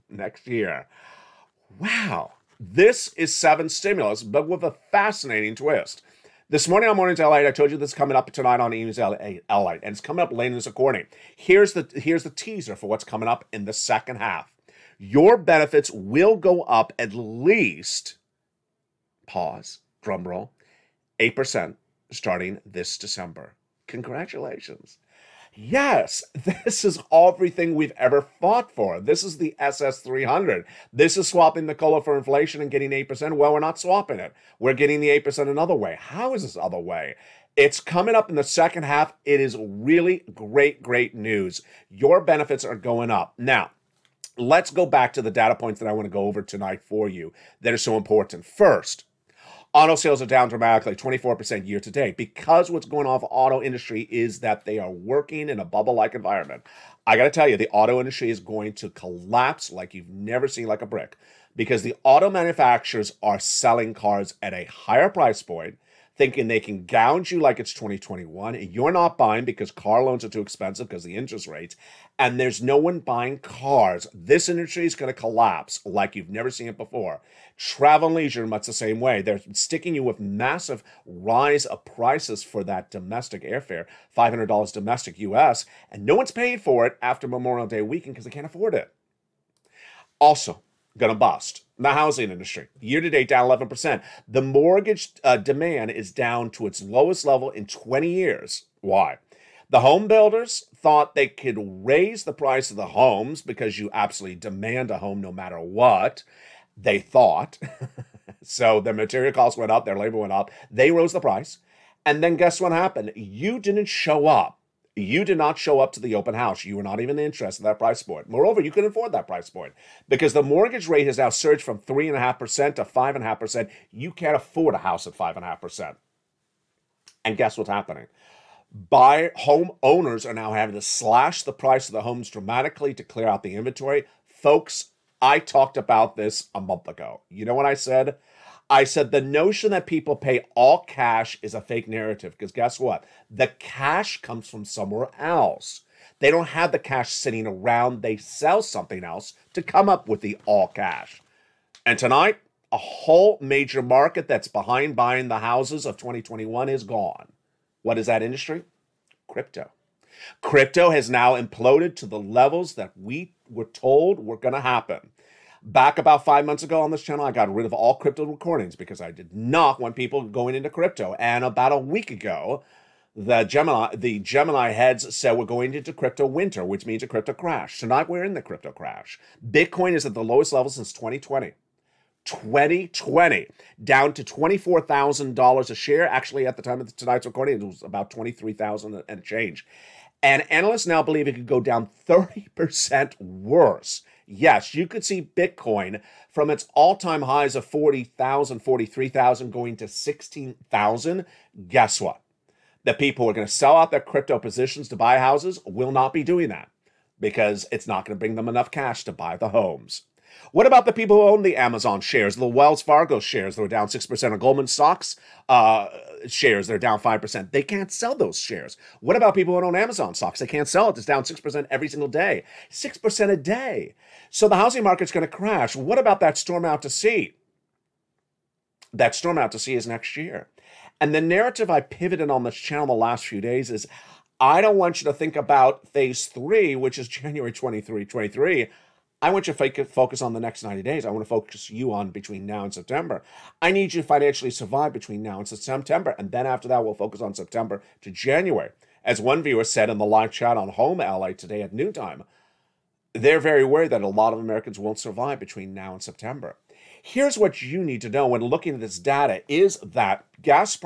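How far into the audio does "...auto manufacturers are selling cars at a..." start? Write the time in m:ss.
1:02.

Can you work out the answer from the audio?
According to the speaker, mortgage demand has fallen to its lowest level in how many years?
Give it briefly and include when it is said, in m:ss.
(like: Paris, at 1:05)
20 years, at 1:37.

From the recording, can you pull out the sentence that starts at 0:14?
Your benefits will go up at least pause, drum roll, eight percent starting this December.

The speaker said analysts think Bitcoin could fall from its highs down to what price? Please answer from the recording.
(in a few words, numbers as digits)
16,000.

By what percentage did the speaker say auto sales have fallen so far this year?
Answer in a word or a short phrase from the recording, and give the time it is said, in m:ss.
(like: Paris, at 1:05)
24%, at 0:50.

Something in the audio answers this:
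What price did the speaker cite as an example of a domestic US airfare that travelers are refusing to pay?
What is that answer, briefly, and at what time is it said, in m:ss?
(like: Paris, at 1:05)
$500, at 1:24.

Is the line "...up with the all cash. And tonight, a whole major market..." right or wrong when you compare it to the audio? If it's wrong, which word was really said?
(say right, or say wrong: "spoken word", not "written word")
right.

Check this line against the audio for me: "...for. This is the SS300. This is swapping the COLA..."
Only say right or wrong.
right.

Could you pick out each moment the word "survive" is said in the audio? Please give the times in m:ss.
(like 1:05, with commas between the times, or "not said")
4:04, 4:14.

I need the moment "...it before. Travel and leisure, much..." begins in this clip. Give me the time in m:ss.
1:16.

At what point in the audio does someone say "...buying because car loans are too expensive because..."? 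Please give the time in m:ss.
1:09.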